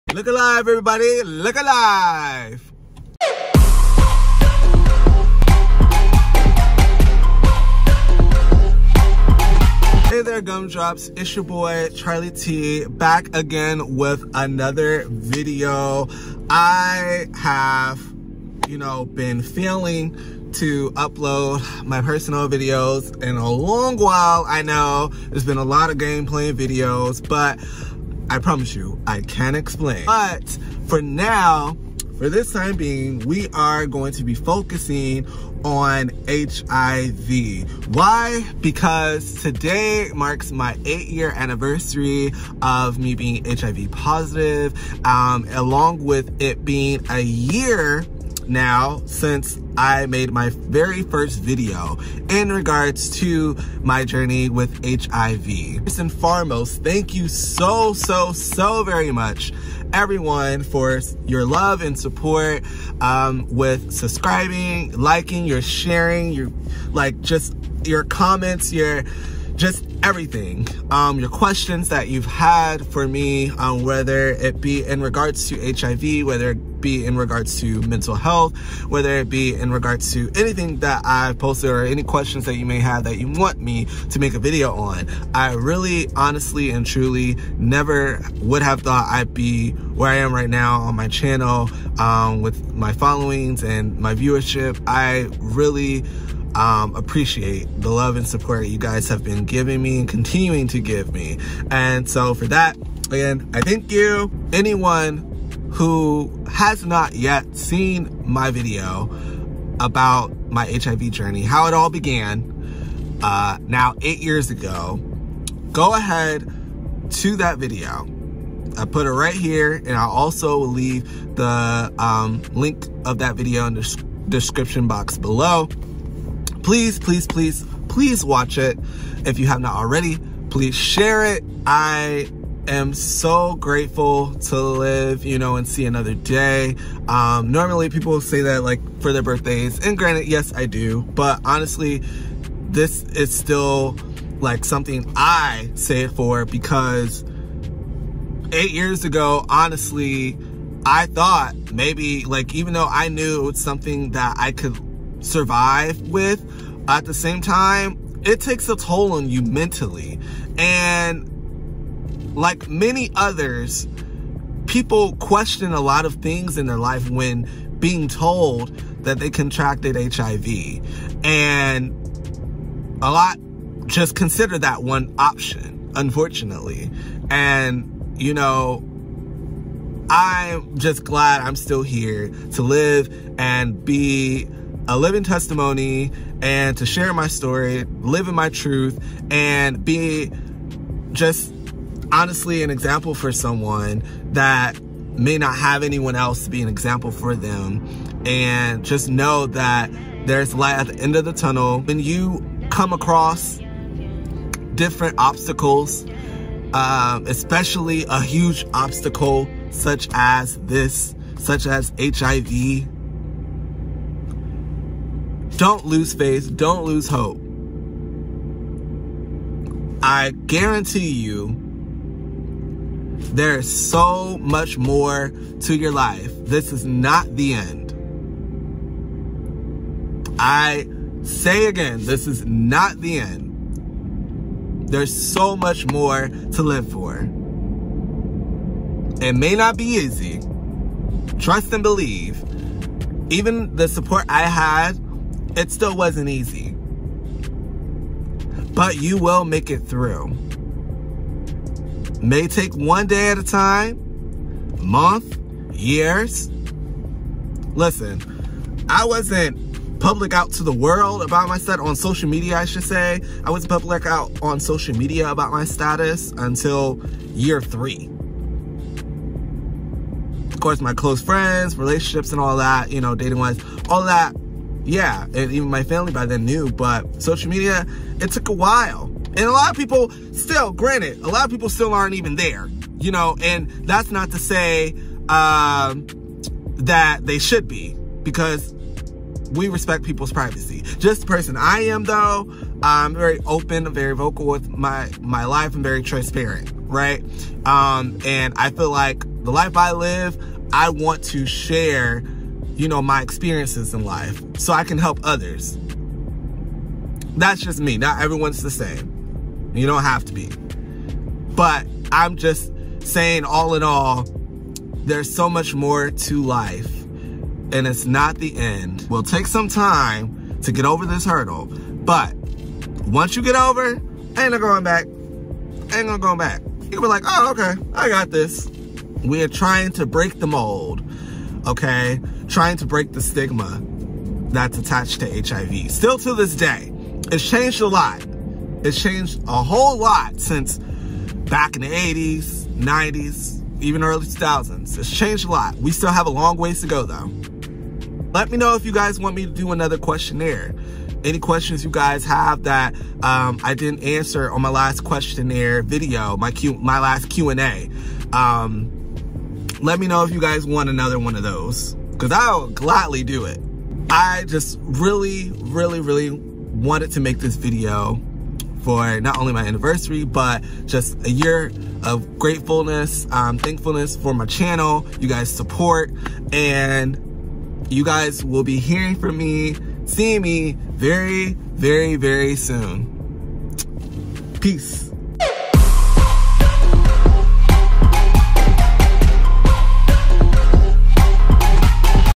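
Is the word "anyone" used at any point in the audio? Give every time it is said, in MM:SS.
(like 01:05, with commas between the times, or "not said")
01:44, 03:15.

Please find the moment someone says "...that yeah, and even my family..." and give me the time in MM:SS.
04:34.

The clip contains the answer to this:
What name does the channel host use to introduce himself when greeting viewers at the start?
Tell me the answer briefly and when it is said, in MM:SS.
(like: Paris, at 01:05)
Charley Tii, at 00:11.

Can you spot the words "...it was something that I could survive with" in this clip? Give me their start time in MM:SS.
02:33.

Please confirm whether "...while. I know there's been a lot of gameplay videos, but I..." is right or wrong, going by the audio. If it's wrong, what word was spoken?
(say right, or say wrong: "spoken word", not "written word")
right.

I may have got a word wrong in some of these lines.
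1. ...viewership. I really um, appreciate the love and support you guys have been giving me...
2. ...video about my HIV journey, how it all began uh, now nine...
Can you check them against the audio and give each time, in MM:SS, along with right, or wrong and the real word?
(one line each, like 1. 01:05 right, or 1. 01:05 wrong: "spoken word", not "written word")
1. 01:34 right
2. 01:48 wrong: "eight", not "nine".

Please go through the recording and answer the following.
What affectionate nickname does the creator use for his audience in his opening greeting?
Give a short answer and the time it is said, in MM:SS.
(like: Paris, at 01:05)
gumdrops, at 00:10.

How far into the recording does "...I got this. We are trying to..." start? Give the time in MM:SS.
05:27.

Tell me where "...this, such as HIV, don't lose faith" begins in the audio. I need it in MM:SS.
03:30.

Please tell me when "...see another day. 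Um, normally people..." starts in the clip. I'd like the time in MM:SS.
02:15.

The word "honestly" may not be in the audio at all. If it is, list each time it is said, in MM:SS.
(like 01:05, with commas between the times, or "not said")
01:26, 02:21, 02:29, 03:12.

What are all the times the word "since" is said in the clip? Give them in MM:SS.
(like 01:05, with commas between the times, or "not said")
00:49, 05:40.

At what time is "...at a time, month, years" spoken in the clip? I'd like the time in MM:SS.
04:13.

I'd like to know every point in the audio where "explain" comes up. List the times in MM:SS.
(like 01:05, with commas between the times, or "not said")
00:29.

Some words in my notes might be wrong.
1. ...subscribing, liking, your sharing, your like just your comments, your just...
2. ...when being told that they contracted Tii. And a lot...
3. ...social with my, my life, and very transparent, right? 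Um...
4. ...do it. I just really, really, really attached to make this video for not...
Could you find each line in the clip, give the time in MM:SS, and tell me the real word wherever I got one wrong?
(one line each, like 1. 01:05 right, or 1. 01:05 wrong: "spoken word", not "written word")
1. 01:03 right
2. 02:47 wrong: "HIV", not "Tii"
3. 04:54 wrong: "vocal", not "social"
4. 06:03 wrong: "wanted", not "attached".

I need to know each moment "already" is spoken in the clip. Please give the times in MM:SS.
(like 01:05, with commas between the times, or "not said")
02:09.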